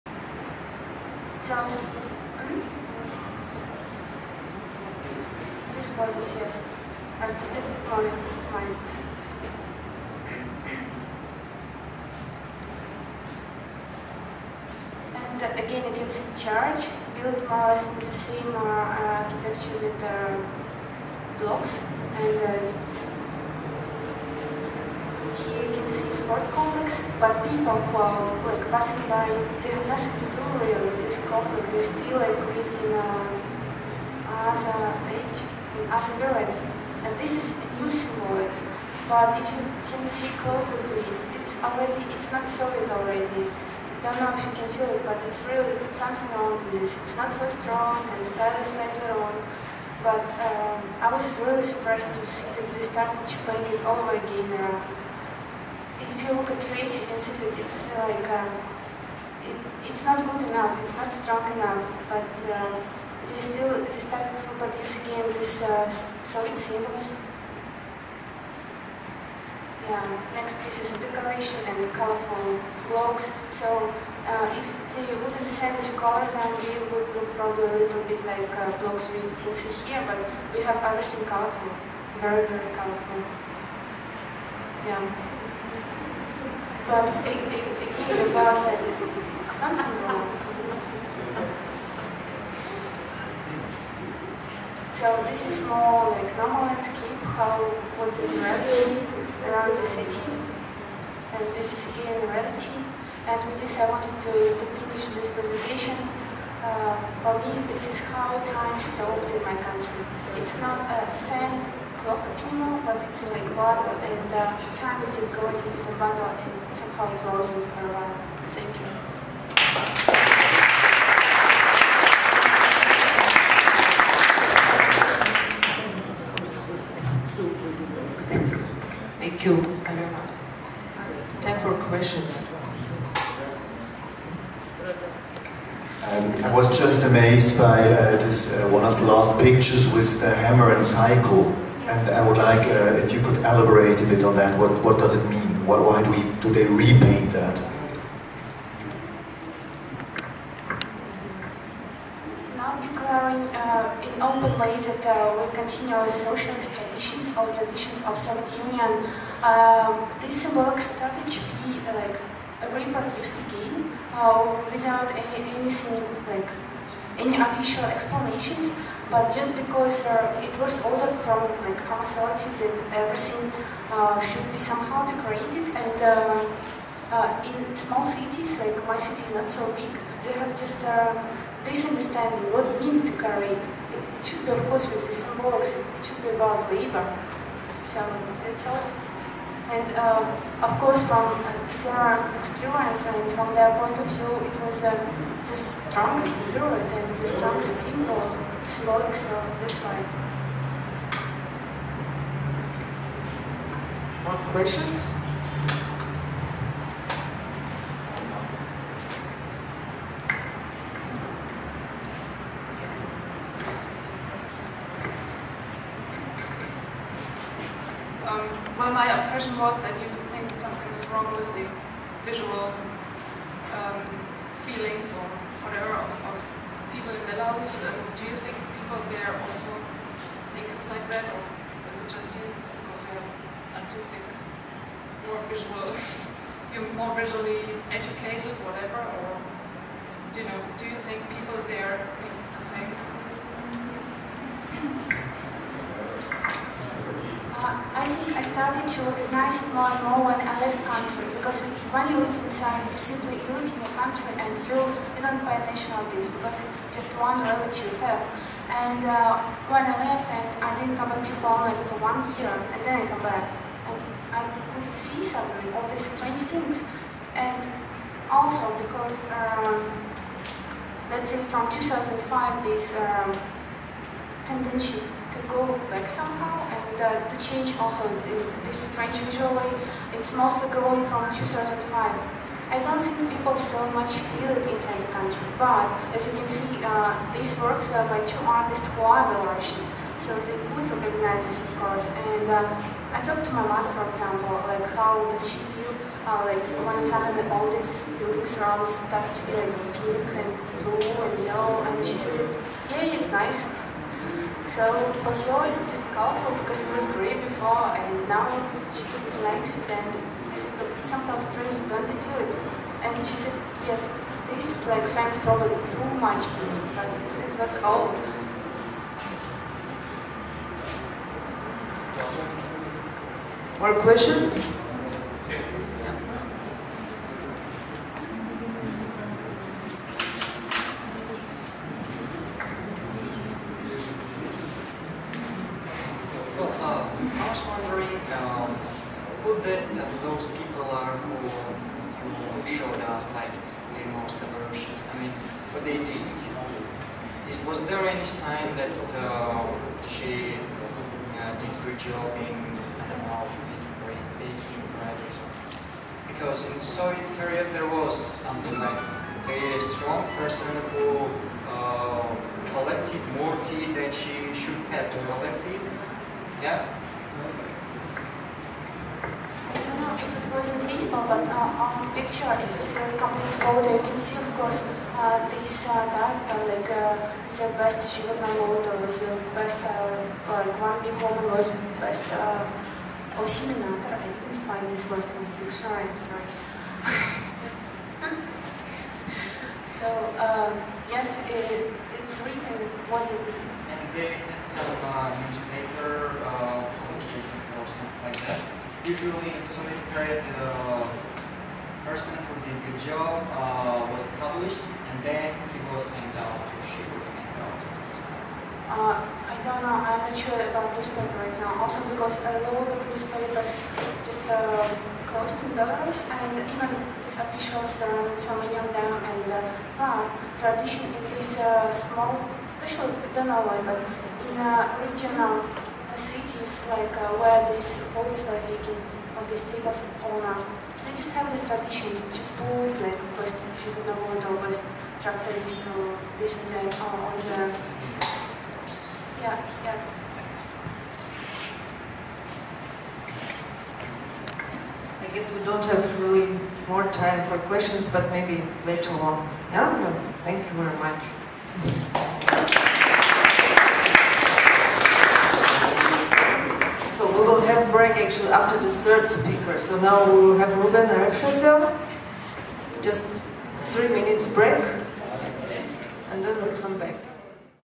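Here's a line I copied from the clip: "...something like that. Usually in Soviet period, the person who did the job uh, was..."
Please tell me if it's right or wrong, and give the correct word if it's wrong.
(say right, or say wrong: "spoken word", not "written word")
right.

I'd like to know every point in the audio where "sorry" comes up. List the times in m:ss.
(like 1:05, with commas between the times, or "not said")
6:26.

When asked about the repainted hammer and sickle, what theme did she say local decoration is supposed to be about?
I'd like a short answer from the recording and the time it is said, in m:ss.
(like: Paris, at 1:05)
labor, at 3:06.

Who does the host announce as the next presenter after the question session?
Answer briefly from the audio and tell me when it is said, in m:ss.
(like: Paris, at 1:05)
Ruben Refshetel, at 7:40.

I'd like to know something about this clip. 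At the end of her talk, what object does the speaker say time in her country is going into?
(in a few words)
a big bottle.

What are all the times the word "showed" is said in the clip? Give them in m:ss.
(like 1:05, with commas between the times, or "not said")
5:42.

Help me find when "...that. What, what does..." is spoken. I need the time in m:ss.
2:24.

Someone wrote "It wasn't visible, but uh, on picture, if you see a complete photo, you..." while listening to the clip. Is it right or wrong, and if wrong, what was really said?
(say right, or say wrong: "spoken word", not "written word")
right.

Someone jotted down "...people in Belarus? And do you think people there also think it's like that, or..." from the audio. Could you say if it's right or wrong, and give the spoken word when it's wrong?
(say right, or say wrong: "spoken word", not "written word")
right.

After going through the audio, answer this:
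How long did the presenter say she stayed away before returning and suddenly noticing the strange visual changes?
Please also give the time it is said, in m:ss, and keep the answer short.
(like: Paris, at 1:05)
one year, at 4:22.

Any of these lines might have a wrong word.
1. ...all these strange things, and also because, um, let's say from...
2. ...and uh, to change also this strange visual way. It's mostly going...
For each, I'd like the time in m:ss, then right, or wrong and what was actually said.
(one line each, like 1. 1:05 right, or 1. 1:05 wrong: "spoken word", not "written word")
1. 4:25 right
2. 4:36 right.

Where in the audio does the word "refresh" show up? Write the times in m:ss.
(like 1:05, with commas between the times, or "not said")
not said.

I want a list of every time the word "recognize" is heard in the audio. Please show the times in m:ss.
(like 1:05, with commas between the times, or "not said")
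4:09, 4:50.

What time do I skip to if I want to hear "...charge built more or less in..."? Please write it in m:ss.
0:16.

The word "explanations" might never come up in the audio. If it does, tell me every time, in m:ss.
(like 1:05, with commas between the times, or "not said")
2:47.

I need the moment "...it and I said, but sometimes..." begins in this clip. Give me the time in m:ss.
5:09.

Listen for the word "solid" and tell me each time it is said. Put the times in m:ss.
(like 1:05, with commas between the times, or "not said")
0:42, 1:05.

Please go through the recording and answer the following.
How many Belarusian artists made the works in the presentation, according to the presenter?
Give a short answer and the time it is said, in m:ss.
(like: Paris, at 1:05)
2, at 4:48.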